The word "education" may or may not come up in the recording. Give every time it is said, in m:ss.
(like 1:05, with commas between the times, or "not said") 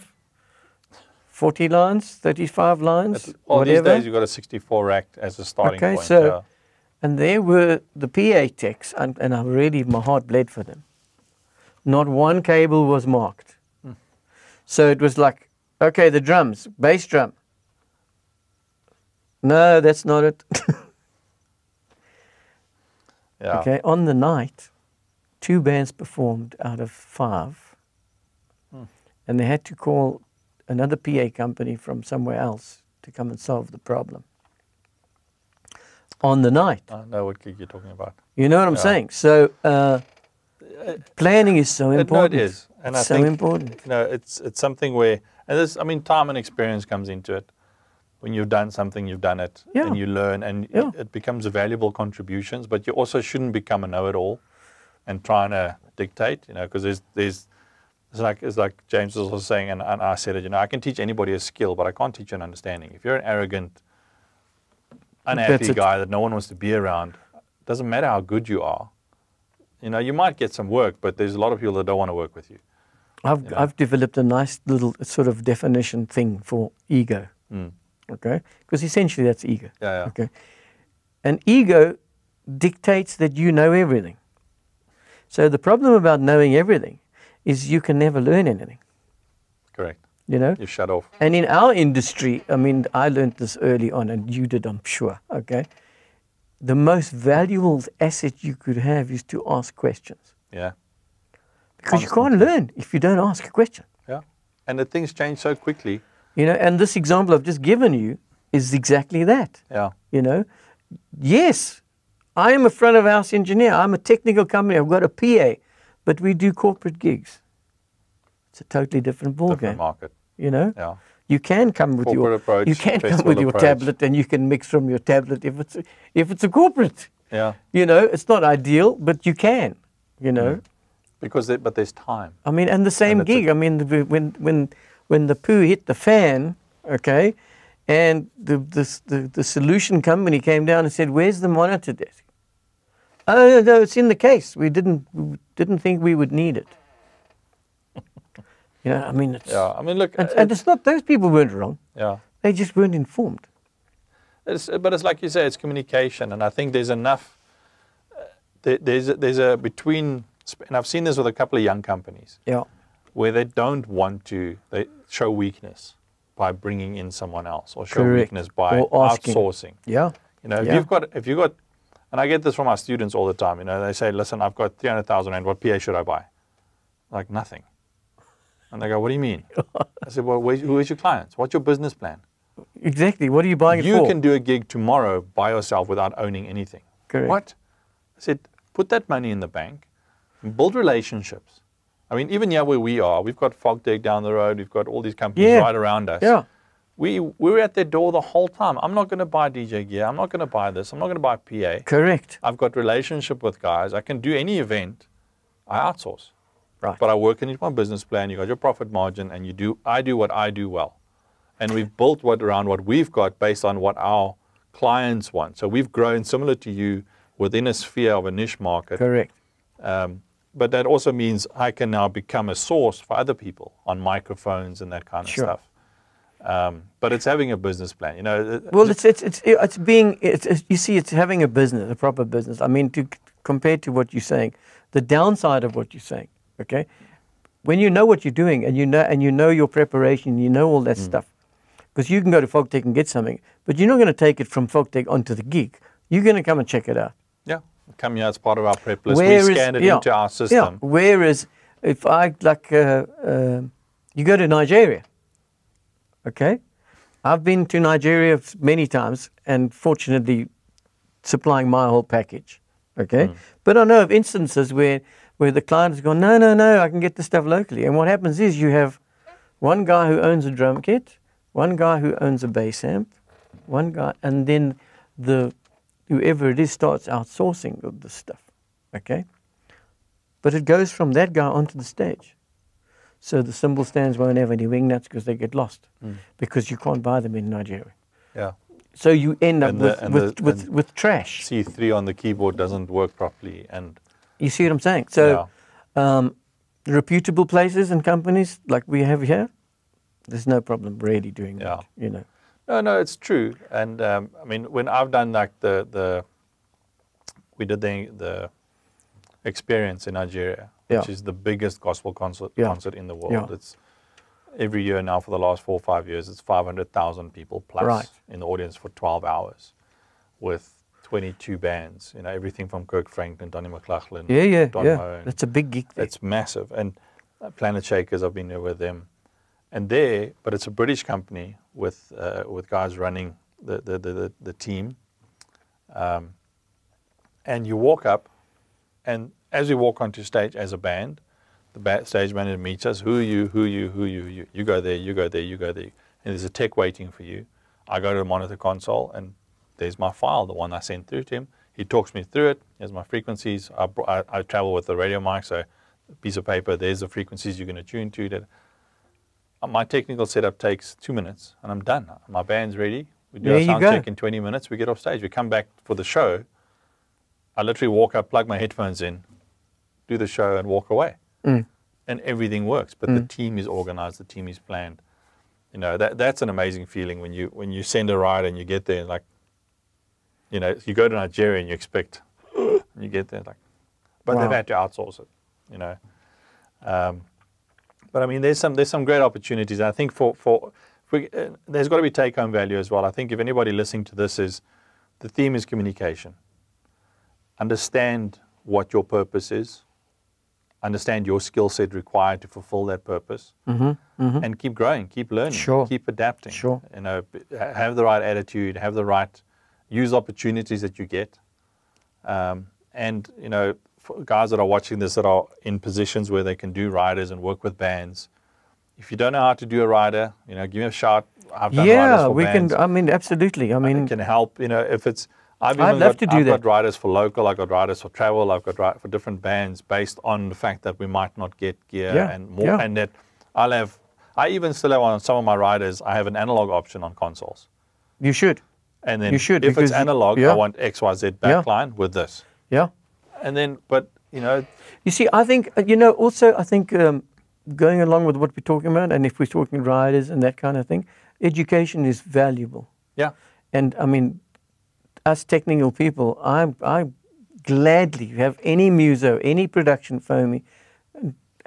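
7:31.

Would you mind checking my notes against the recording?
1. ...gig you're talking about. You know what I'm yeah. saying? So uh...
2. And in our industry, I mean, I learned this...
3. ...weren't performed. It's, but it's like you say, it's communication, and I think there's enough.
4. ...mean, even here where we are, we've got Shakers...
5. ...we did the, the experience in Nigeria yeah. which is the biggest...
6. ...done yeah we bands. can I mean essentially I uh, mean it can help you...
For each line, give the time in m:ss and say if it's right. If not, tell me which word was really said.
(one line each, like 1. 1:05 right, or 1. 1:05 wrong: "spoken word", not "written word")
1. 0:37 right
2. 1:31 right
3. 2:32 wrong: "informed", not "performed"
4. 3:12 wrong: "Fogtech", not "Shakers"
5. 5:07 right
6. 7:01 wrong: "absolutely", not "essentially".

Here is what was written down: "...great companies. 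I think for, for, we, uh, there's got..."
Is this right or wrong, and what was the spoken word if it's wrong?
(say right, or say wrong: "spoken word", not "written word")
wrong: "opportunities", not "companies".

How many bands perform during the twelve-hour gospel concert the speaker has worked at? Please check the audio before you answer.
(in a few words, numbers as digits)
22.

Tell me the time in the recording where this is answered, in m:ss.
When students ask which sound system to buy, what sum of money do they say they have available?
2:54.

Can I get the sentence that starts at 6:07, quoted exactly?
I literally walk up, plug my headphones in, do the show and walk away.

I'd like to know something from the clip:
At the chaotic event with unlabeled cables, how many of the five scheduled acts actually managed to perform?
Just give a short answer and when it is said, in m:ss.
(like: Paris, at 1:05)
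2, at 0:25.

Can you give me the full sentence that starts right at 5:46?
And there's a tech waiting for you.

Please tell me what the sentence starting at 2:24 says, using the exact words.
We didn't we didn't think we would need it.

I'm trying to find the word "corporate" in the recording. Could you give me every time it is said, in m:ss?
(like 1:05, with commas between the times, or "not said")
1:56, 2:02, 2:06.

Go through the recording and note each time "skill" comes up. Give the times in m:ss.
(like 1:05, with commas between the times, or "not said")
1:01, 6:41.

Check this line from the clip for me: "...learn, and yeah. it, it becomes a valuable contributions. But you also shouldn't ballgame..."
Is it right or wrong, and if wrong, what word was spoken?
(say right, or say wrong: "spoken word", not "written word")
wrong: "become", not "ballgame".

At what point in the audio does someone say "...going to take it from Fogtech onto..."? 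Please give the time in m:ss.
4:03.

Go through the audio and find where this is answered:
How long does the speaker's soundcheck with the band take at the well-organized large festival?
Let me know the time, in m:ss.
6:04.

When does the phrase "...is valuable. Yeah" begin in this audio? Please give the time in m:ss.
7:32.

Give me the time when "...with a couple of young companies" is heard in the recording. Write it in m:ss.
2:41.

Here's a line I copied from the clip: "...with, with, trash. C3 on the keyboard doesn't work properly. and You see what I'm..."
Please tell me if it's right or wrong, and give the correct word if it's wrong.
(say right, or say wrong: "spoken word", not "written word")
right.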